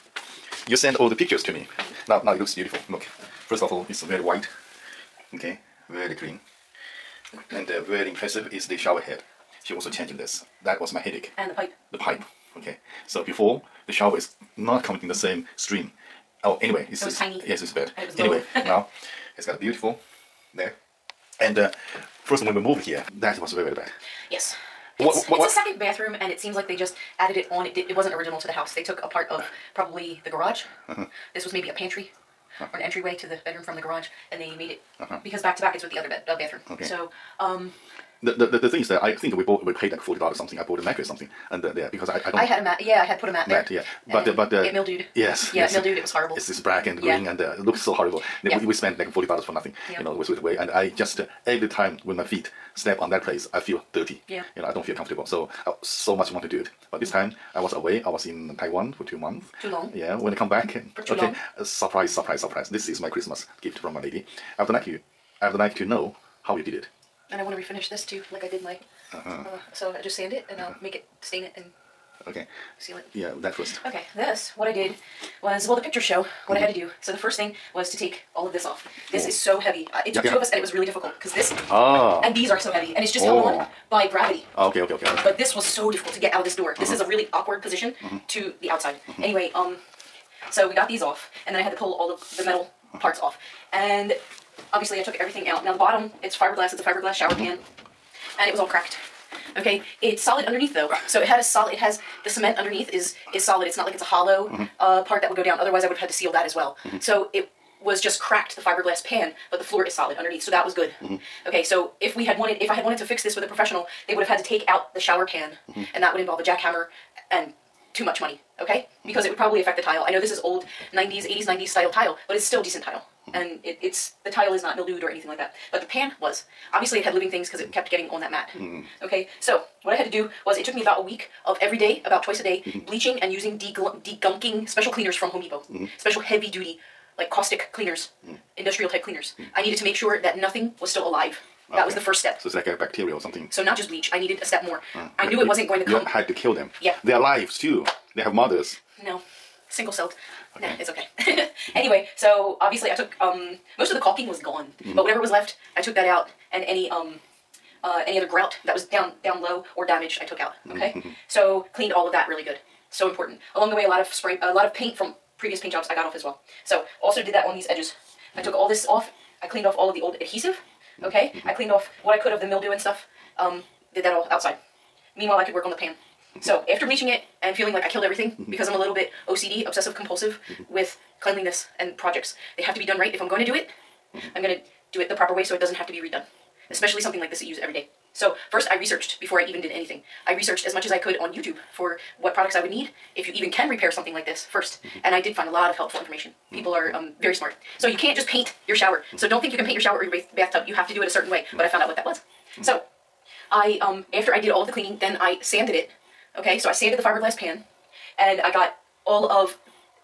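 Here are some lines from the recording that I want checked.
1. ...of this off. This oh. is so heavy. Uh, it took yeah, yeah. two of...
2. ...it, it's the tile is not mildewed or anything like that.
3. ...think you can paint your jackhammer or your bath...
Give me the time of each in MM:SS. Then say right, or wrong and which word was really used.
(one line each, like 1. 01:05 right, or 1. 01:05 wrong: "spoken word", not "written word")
1. 01:18 right
2. 02:03 right
3. 03:19 wrong: "shower", not "jackhammer".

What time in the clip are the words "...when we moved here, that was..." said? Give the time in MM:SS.
00:22.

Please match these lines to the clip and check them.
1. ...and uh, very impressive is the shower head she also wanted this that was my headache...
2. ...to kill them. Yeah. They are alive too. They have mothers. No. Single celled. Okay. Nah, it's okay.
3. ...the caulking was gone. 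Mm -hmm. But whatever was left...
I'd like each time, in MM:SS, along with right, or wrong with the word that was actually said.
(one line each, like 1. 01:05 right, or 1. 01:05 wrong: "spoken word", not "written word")
1. 00:07 wrong: "changed", not "wanted"
2. 02:26 right
3. 02:33 right.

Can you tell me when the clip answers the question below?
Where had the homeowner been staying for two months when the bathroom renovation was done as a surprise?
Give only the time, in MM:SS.
00:58.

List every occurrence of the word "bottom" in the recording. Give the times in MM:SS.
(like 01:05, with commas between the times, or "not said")
01:35.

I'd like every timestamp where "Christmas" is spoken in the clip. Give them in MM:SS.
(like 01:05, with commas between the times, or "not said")
01:03.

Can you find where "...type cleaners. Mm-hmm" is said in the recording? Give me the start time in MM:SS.
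02:18.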